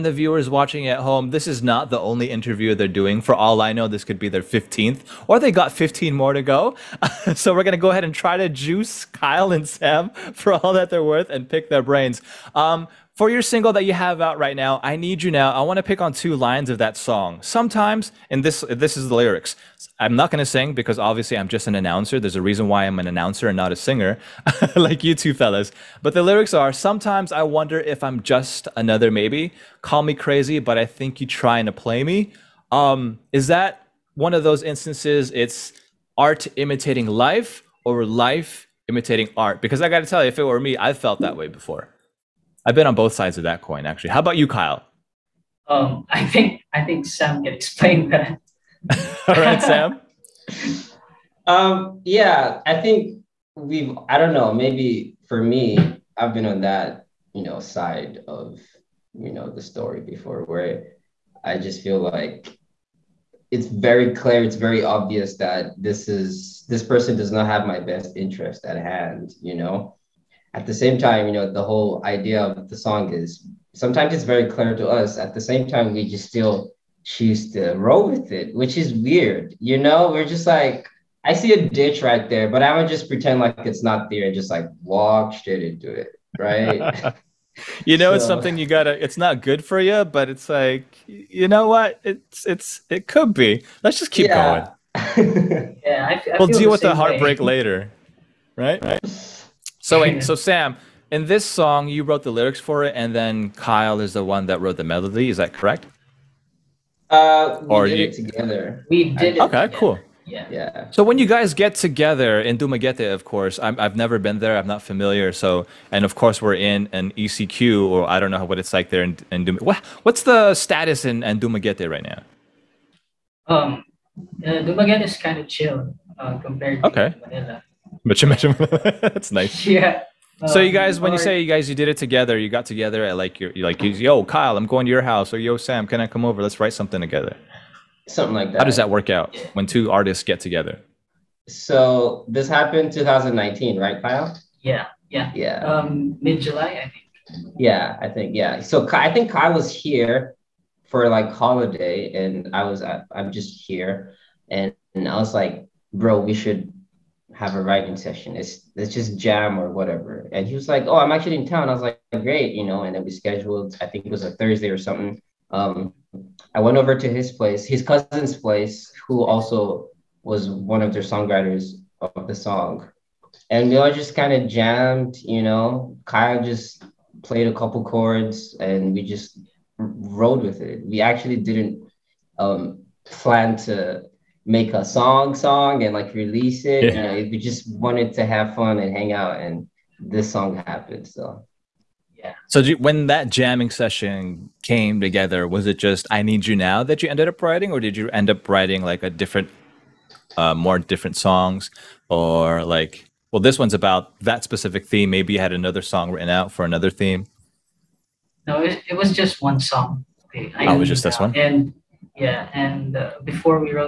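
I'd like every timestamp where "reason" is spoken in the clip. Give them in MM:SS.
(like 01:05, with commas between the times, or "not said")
00:22.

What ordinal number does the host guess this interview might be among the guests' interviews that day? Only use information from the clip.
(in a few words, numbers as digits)
15th.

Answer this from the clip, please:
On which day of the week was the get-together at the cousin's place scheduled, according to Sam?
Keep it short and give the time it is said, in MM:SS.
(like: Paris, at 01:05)
Thursday, at 02:44.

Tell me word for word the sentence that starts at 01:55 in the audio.
So, and of course, we're in an ECQ, or I don't know what it's like there in, in Dumaguete.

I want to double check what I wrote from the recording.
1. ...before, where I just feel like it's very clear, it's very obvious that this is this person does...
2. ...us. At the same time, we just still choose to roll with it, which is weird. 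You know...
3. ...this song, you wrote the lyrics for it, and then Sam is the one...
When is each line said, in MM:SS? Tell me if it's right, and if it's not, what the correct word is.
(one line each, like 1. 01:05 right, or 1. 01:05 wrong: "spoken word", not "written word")
1. 01:00 right
2. 01:14 right
3. 01:41 wrong: "Kyle", not "Sam".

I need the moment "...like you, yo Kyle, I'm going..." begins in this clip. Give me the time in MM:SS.
02:13.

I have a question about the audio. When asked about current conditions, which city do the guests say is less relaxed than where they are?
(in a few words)
Manila.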